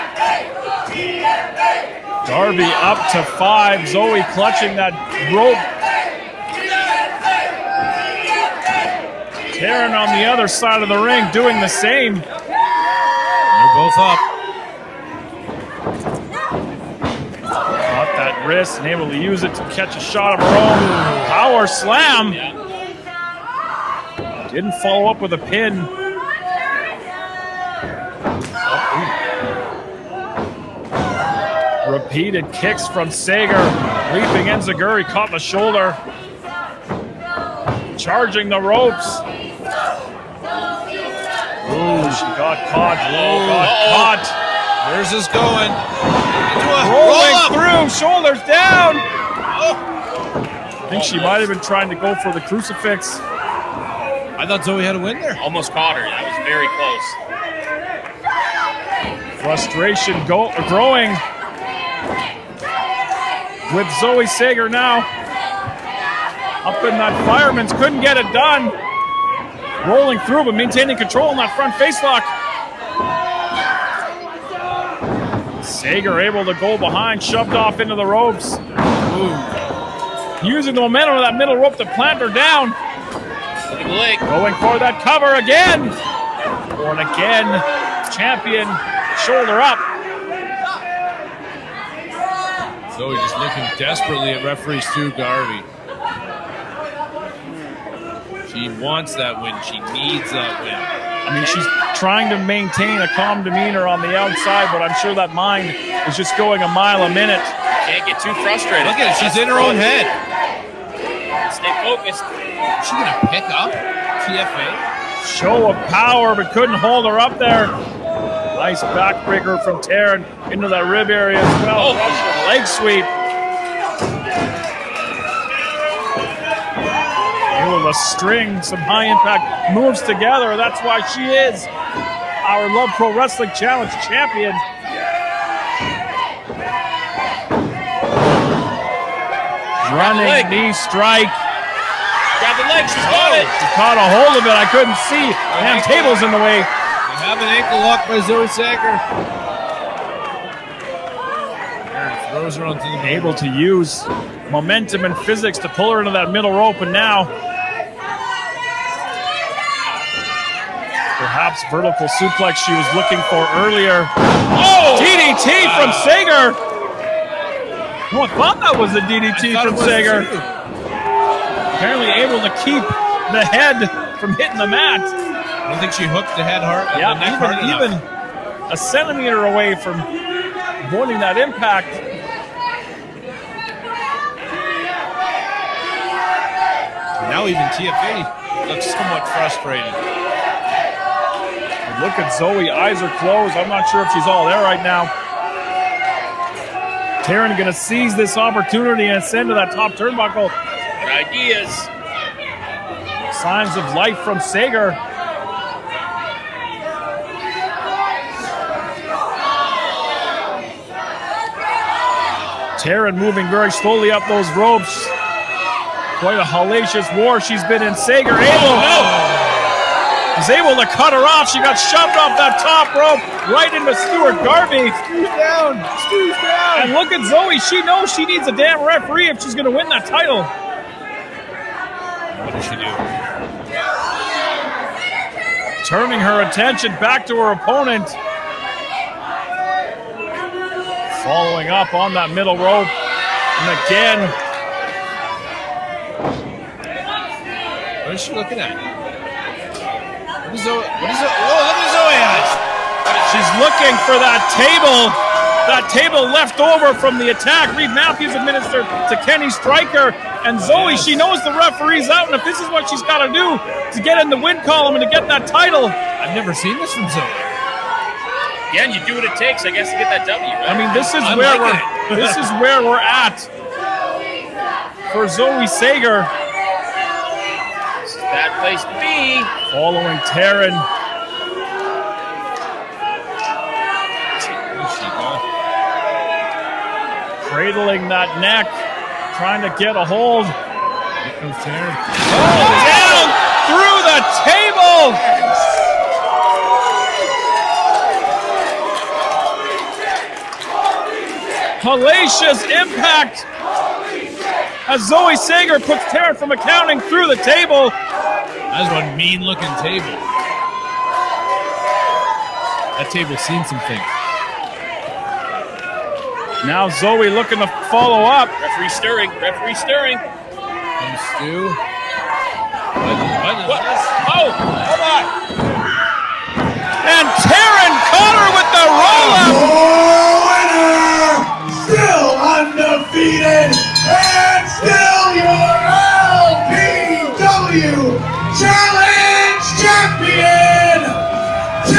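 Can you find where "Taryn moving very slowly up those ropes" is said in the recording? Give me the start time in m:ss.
3:32.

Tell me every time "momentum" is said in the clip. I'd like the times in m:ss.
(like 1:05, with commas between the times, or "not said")
1:20, 2:34.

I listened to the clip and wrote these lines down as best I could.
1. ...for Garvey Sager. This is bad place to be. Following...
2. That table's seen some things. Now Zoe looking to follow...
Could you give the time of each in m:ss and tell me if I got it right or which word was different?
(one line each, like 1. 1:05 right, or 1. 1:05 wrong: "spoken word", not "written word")
1. 4:35 wrong: "Zoe", not "Garvey"
2. 5:12 right.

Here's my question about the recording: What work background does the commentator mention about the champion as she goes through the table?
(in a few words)
accounting.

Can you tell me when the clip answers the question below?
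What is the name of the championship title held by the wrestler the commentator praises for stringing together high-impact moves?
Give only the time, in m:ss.
2:12.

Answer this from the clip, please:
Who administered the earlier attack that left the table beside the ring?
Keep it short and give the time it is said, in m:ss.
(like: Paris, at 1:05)
Reed Matthews, at 4:17.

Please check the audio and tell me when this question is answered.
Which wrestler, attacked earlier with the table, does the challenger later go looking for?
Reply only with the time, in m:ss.
4:19.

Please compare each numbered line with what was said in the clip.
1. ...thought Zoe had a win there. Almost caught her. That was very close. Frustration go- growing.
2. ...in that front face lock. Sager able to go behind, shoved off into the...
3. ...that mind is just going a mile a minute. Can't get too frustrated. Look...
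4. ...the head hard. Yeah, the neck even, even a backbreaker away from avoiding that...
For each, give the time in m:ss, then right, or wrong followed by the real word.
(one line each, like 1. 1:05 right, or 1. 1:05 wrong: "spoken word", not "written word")
1. 0:54 right
2. 1:11 right
3. 1:45 right
4. 2:56 wrong: "centimeter", not "backbreaker".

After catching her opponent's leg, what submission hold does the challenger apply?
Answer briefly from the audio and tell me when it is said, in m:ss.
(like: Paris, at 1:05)
ankle lock, at 2:27.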